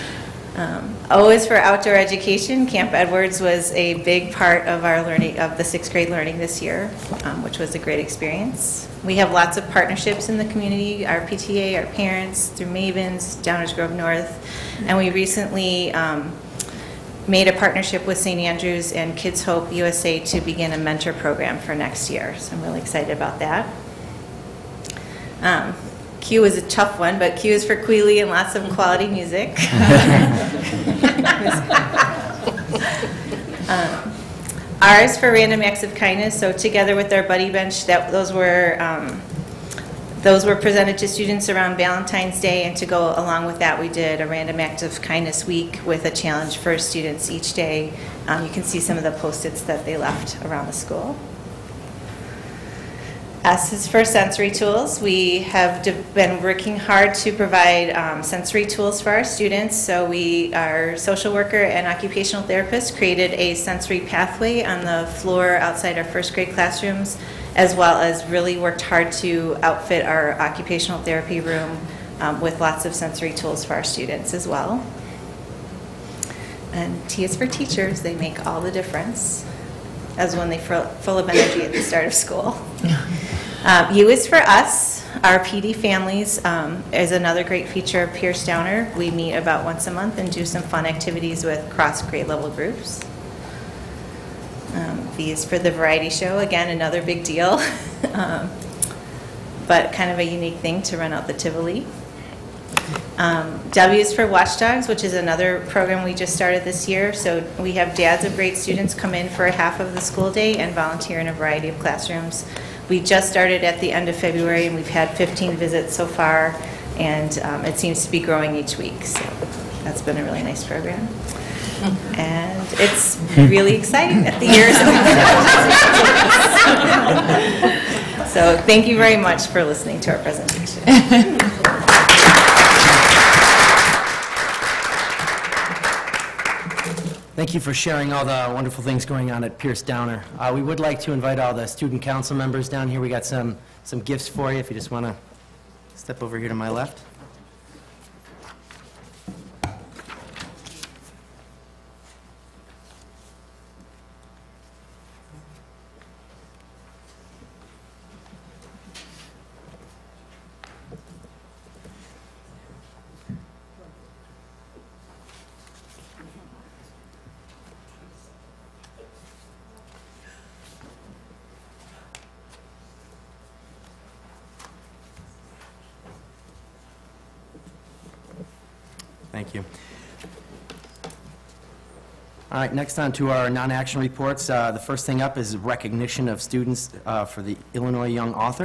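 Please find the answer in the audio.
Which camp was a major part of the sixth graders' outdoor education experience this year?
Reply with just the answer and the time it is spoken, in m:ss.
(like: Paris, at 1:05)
Camp Edwards, at 0:02.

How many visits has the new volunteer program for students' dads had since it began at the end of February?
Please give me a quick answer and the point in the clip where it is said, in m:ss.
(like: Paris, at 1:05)
15, at 1:55.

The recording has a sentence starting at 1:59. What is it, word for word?
So that's been a really nice program.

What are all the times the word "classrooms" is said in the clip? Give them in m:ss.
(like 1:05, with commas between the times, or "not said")
1:06, 1:51.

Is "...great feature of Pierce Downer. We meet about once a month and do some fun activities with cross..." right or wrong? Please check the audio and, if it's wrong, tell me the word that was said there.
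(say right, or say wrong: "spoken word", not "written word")
right.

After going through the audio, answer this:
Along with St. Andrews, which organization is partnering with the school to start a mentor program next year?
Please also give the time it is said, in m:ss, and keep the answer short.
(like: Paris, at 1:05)
Kids Hope USA, at 0:19.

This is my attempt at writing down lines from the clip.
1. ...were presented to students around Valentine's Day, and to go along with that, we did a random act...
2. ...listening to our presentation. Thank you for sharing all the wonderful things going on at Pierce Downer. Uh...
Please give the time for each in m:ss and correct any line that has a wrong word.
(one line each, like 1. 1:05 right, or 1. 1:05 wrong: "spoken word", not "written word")
1. 0:40 right
2. 2:09 right.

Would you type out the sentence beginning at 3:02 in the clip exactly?
All right, next on to our non-action reports.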